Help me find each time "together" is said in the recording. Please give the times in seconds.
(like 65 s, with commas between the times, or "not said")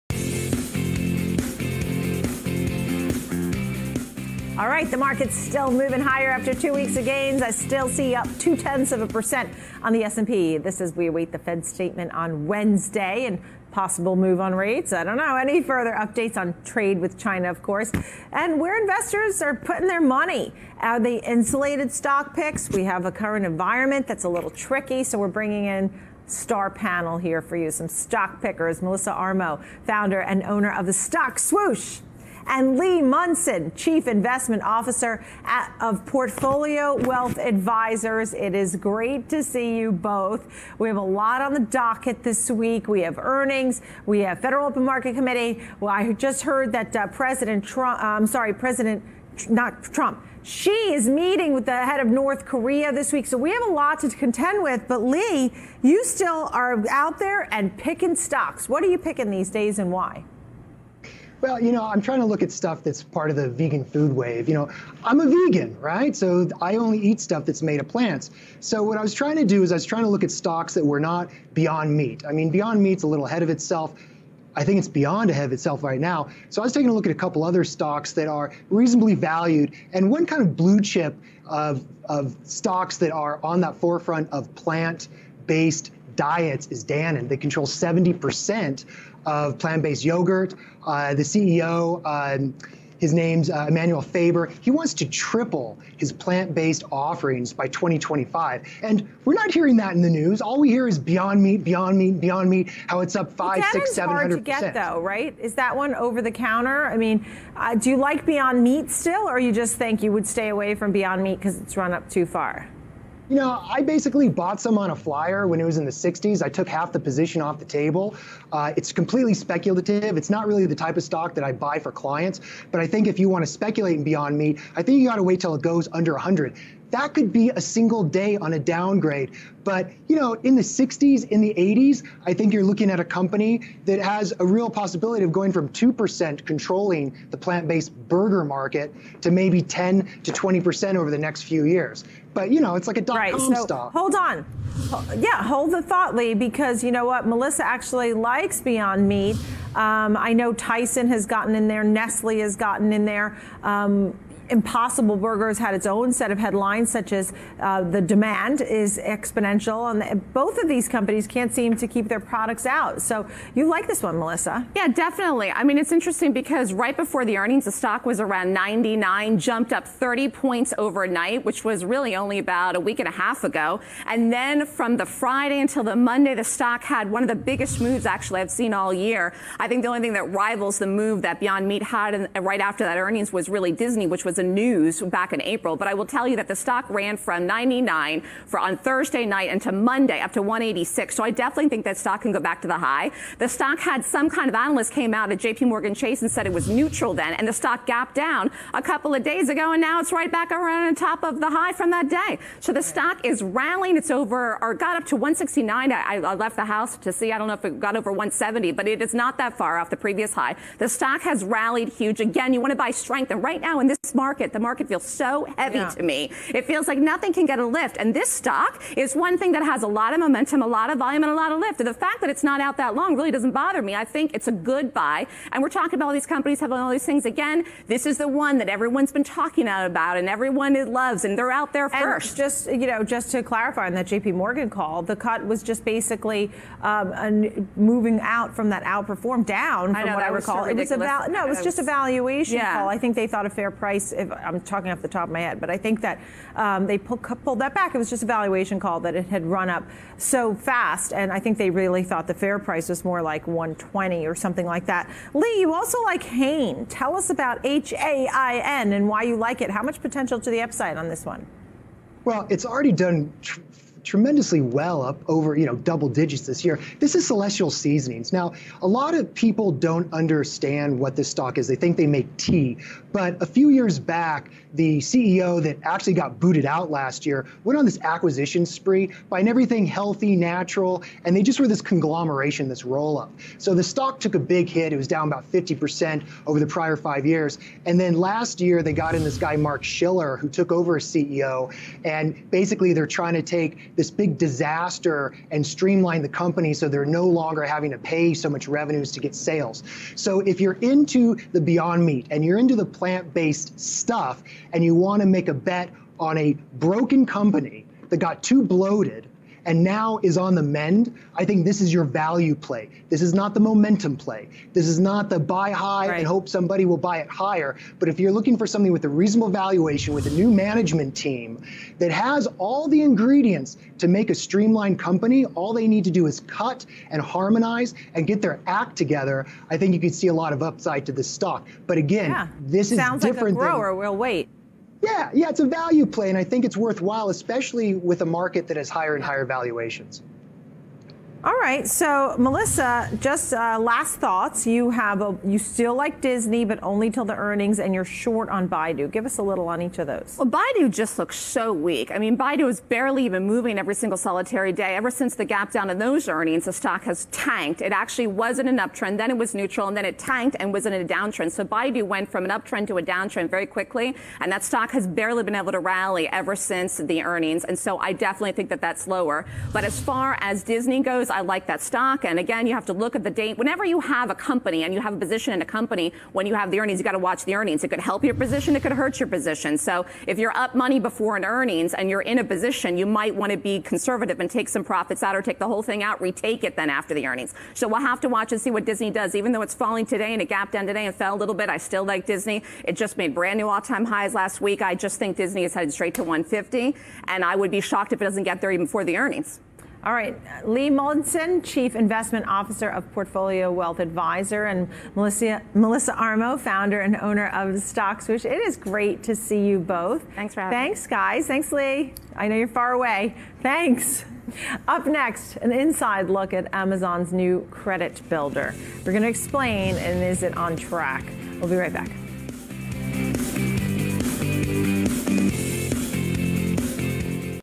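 328 s.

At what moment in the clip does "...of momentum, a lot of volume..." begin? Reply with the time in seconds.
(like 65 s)
220 s.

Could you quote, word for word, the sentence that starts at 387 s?
So we'll have to watch and see what Disney does.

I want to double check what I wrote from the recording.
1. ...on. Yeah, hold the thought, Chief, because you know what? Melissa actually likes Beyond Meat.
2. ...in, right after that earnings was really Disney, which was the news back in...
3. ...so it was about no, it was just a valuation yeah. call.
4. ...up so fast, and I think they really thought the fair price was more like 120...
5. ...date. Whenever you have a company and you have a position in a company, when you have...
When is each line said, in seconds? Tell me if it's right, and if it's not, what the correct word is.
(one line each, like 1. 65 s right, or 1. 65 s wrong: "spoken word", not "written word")
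1. 144 s wrong: "Lee", not "Chief"
2. 182 s right
3. 240 s right
4. 249 s right
5. 373 s right.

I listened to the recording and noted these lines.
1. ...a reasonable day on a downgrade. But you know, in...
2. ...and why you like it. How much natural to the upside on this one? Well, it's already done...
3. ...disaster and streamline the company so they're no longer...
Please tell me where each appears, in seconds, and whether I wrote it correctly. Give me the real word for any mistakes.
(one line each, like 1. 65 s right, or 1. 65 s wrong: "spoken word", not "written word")
1. 127 s wrong: "single", not "reasonable"
2. 258 s wrong: "potential", not "natural"
3. 294 s right.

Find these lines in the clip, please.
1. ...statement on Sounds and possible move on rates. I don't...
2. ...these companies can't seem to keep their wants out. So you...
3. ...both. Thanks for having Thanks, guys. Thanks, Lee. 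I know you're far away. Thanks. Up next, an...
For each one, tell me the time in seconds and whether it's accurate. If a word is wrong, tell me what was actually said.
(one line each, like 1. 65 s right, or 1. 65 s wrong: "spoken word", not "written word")
1. 11 s wrong: "Wednesday", not "Sounds"
2. 160 s wrong: "products", not "wants"
3. 409 s right.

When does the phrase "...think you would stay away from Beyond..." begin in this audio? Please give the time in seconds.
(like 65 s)
109 s.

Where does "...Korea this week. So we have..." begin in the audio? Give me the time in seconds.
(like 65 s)
52 s.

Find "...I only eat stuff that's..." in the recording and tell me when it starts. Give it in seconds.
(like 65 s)
66 s.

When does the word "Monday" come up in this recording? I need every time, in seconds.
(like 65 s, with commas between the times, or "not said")
175 s, 189 s.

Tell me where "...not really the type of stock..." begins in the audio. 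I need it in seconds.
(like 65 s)
120 s.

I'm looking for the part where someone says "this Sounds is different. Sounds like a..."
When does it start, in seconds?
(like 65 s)
332 s.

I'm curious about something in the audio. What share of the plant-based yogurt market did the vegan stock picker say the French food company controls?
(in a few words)
70%.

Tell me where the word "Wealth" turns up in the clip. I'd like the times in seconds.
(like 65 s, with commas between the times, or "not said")
37 s, 403 s.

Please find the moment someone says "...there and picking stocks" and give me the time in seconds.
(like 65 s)
57 s.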